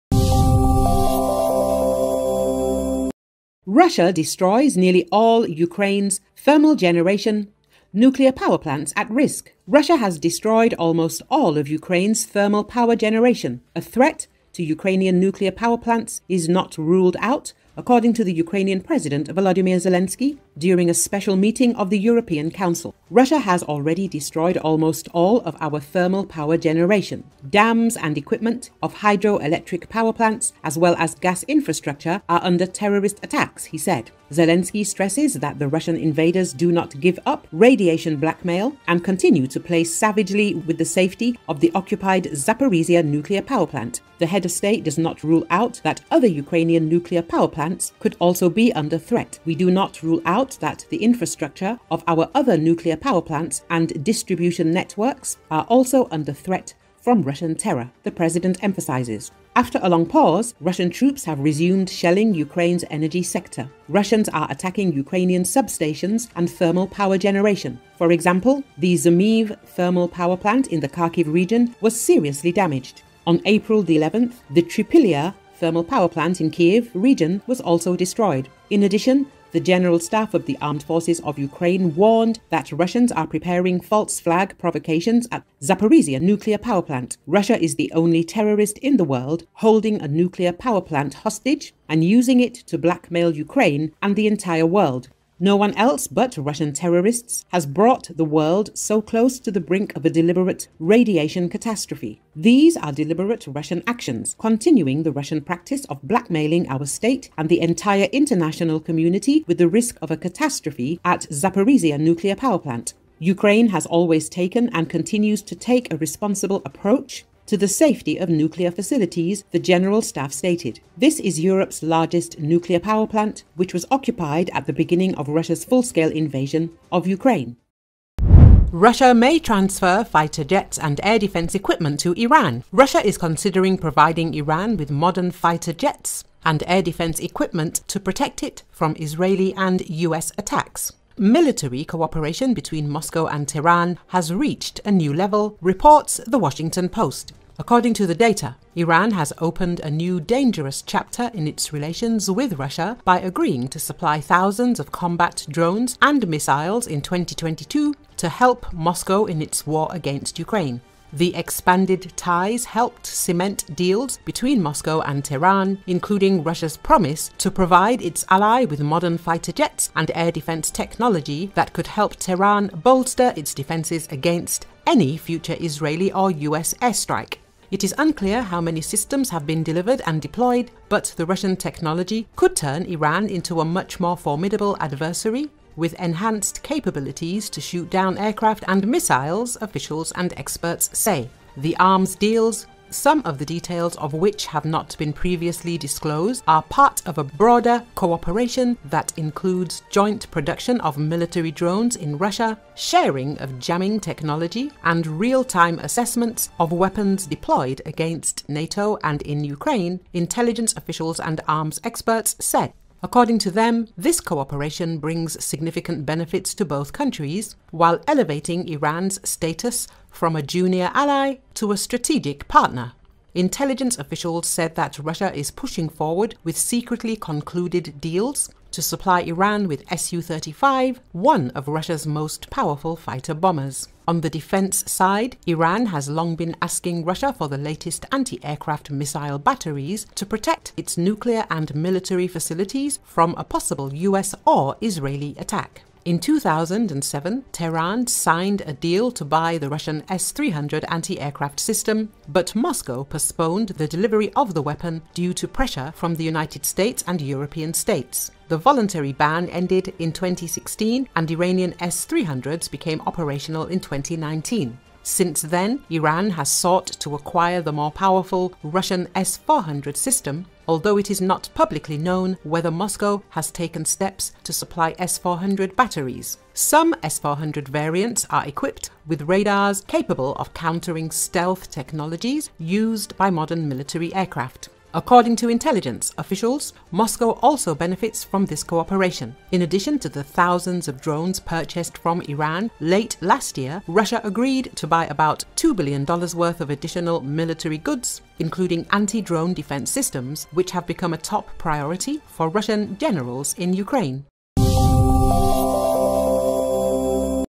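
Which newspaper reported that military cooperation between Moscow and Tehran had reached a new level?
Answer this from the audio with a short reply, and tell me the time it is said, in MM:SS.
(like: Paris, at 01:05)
The Washington Post, at 02:26.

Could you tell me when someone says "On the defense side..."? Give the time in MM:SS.
03:54.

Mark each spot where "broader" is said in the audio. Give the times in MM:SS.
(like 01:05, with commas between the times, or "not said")
03:17.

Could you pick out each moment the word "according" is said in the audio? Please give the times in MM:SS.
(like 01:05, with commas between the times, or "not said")
00:17, 02:27, 03:33, 04:44.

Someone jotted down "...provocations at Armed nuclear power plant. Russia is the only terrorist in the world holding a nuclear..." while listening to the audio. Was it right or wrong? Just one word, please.
wrong.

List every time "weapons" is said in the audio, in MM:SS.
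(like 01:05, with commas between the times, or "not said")
03:26, 04:14.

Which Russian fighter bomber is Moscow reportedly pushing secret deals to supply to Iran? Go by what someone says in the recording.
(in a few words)
Su-35.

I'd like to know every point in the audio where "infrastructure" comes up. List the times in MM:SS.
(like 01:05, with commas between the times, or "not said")
00:31, 00:51.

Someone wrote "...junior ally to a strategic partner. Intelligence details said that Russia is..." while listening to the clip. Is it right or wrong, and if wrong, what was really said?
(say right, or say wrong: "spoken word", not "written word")
wrong: "officials", not "details".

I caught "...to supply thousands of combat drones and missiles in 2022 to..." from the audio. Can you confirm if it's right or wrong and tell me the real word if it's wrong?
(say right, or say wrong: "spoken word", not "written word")
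right.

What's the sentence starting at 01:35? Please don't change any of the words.
No one else but Russian terrorists has brought the world so close to the brink of a deliberate radiation catastrophe.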